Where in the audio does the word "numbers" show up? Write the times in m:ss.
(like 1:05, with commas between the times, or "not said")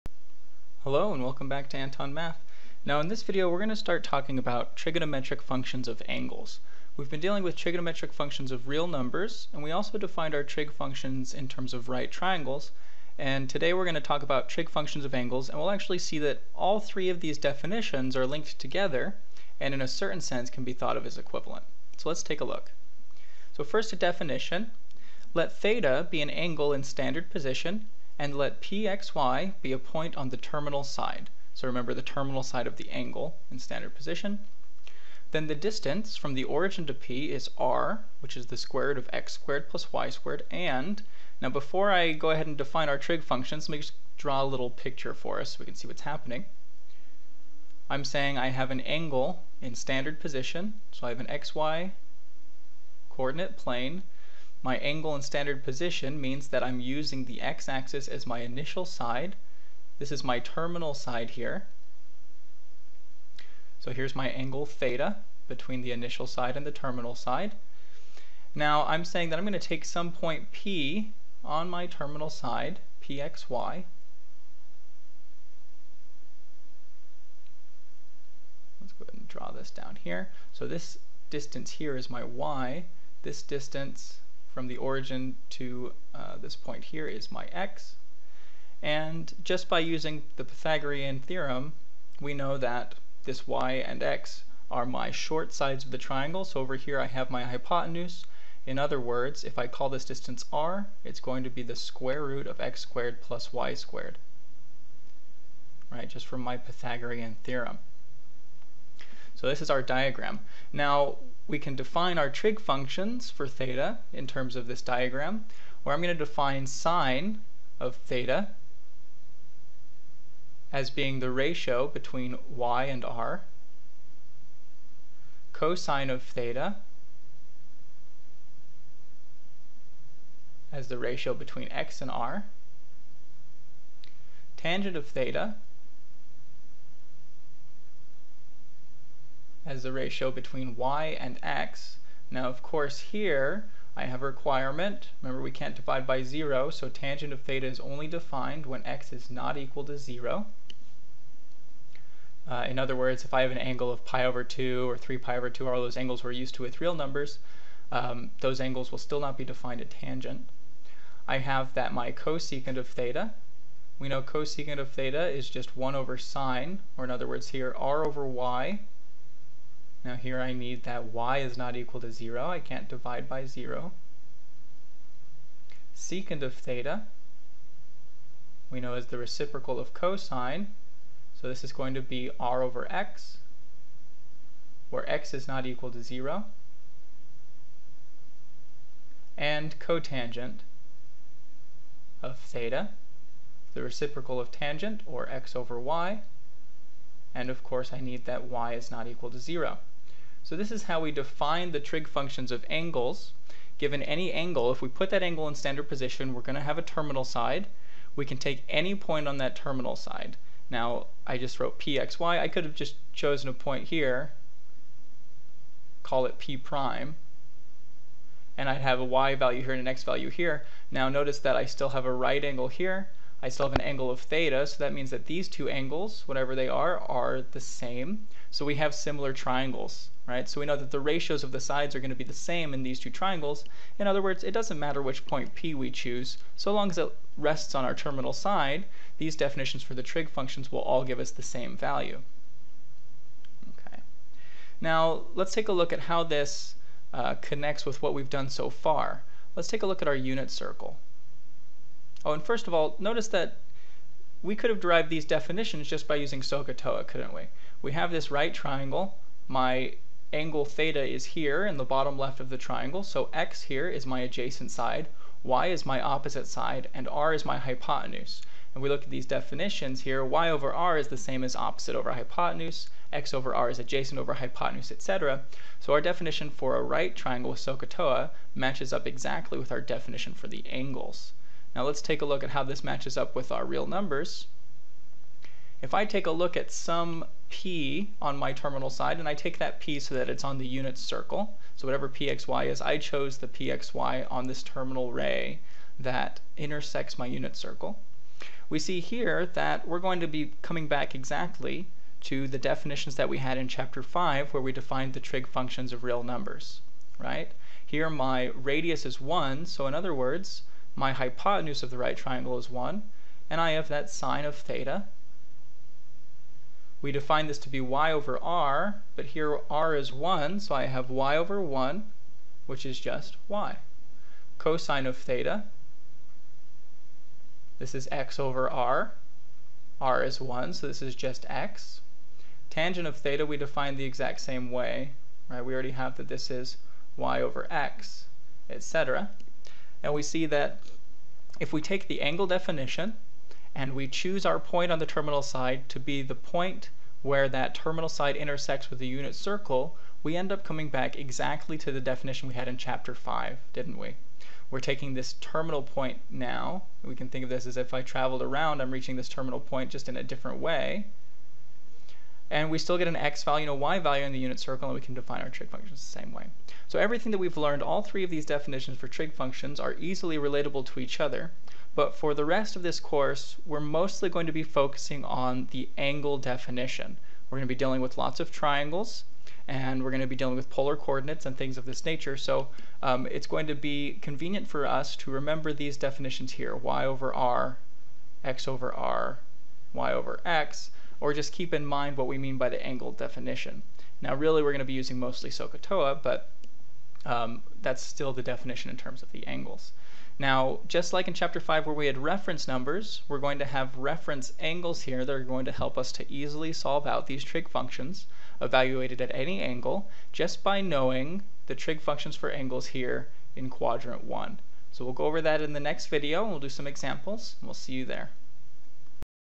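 0:08, 2:36, 4:43, 5:06, 6:42.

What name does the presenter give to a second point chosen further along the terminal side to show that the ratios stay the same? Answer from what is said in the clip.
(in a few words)
p prime.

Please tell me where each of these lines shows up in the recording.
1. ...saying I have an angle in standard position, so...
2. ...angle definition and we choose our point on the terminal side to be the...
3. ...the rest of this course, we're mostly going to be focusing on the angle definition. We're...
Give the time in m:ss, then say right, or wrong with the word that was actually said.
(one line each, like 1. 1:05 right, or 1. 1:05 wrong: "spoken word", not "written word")
1. 0:48 right
2. 5:42 right
3. 6:12 right.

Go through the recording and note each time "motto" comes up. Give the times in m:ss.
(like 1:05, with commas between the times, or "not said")
not said.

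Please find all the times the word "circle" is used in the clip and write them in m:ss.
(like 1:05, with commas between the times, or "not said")
4:10, 4:50, 4:57, 5:49, 6:04.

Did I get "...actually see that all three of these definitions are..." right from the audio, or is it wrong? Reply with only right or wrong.
right.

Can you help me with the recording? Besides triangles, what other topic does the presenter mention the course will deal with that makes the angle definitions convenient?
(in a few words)
polar coordinates.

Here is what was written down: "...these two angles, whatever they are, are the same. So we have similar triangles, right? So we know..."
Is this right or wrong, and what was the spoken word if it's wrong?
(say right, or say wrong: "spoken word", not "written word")
right.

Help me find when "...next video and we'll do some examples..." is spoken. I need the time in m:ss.
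6:55.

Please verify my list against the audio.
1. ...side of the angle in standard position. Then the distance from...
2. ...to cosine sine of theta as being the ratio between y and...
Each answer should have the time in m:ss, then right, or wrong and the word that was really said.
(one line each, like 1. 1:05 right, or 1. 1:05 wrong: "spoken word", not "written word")
1. 0:32 right
2. 1:56 wrong: "define", not "cosine".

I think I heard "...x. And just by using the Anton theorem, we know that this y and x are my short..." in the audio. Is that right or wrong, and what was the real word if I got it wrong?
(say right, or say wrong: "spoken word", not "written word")
wrong: "Pythagorean", not "Anton".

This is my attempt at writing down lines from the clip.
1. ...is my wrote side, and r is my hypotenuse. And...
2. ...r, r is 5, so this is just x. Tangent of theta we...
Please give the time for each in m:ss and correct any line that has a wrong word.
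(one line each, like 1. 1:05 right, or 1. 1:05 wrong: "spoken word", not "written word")
1. 4:25 wrong: "opposite", not "wrote"
2. 5:28 wrong: "1", not "5".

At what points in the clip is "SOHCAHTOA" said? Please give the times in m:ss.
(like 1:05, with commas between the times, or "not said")
4:16, 4:37, 6:35.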